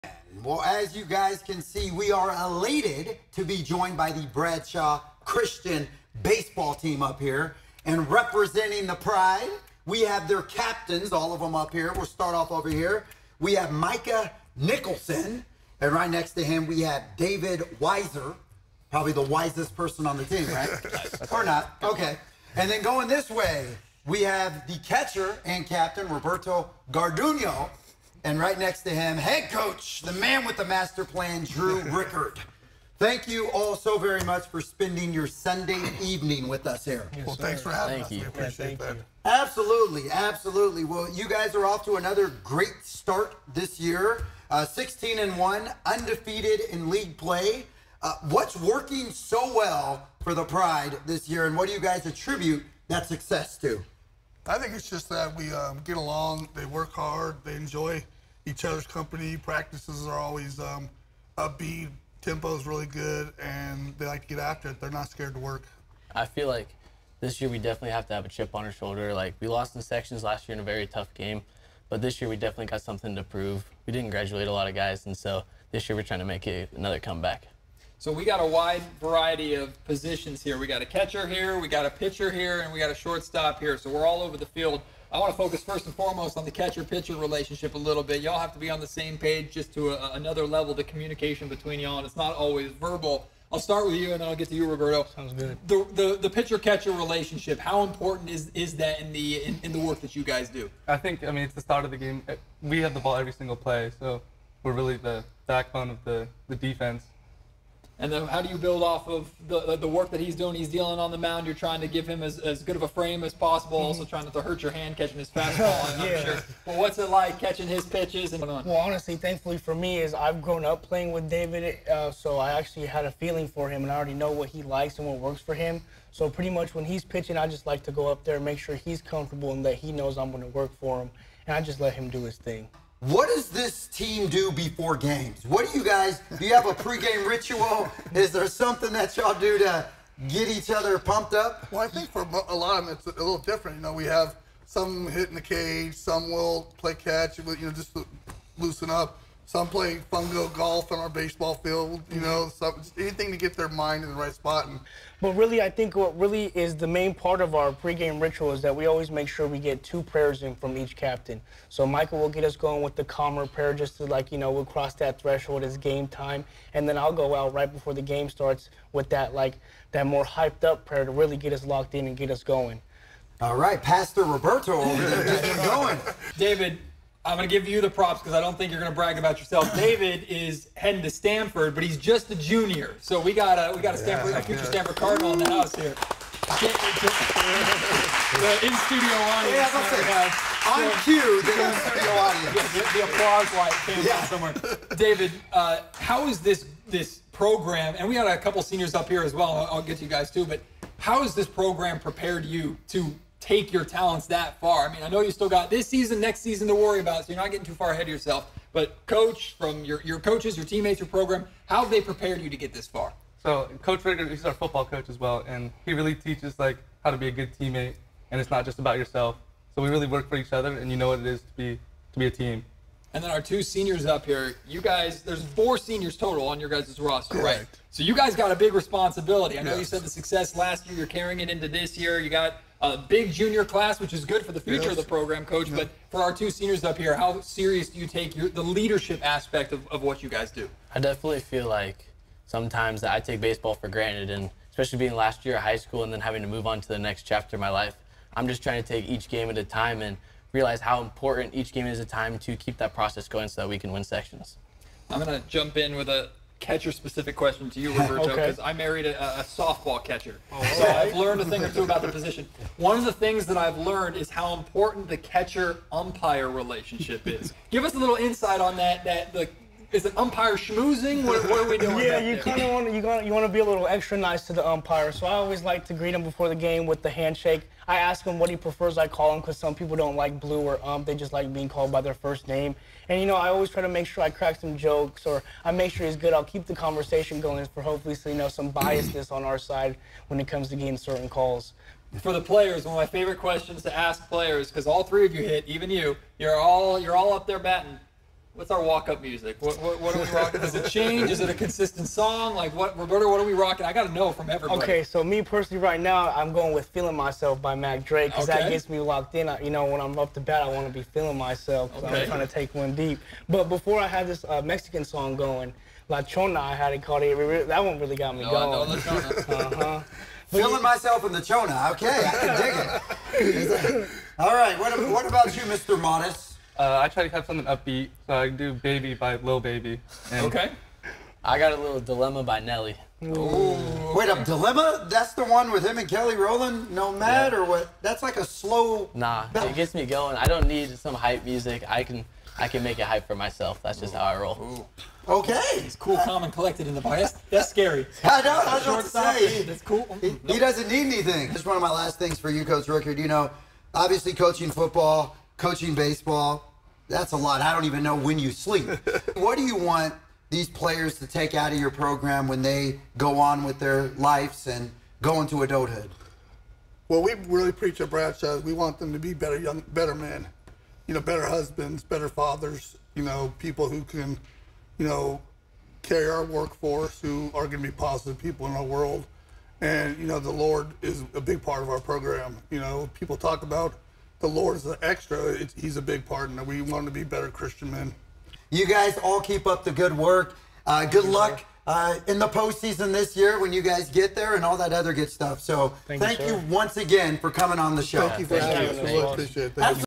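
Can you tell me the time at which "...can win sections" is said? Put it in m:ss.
4:13.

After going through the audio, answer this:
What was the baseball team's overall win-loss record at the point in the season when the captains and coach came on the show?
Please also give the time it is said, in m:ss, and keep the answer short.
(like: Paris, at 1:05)
16-1, at 0:44.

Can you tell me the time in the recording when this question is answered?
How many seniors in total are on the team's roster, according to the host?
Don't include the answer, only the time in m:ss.
3:45.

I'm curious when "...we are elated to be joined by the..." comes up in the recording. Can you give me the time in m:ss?
0:01.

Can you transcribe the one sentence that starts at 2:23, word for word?
You know, we have some hit in the cage, some will play catch, you know, just loosen up.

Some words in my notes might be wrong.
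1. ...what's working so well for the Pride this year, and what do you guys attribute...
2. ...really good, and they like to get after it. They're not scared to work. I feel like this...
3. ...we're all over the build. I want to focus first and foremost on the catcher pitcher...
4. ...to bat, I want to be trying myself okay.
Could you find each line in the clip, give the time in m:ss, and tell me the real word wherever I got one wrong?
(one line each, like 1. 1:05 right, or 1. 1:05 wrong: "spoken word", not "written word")
1. 0:48 right
2. 1:02 right
3. 1:23 wrong: "field", not "build"
4. 5:10 wrong: "feeling", not "trying".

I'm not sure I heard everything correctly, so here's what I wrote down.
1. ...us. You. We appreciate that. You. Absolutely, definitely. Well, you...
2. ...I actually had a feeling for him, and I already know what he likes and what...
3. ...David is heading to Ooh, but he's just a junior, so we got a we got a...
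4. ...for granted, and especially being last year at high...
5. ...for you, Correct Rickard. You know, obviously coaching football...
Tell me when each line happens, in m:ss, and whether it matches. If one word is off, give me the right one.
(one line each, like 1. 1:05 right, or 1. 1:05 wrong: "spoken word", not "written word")
1. 0:38 wrong: "absolutely", not "definitely"
2. 2:02 right
3. 2:59 wrong: "Stanford", not "Ooh"
4. 4:03 right
5. 5:52 wrong: "Coach", not "Correct".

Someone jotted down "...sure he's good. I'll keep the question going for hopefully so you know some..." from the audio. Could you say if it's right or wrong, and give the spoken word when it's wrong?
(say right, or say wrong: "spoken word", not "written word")
wrong: "conversation", not "question".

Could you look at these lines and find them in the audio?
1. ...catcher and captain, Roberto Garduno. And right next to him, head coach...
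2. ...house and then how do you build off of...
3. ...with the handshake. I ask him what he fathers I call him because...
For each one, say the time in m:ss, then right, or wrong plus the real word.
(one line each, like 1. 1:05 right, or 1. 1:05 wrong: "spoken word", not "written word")
1. 0:24 right
2. 1:46 wrong: "defense", not "house"
3. 4:36 wrong: "prefers", not "fathers".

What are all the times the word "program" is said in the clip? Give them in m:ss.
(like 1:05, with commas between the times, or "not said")
3:17, 3:21, 3:31, 3:55, 6:01, 6:21.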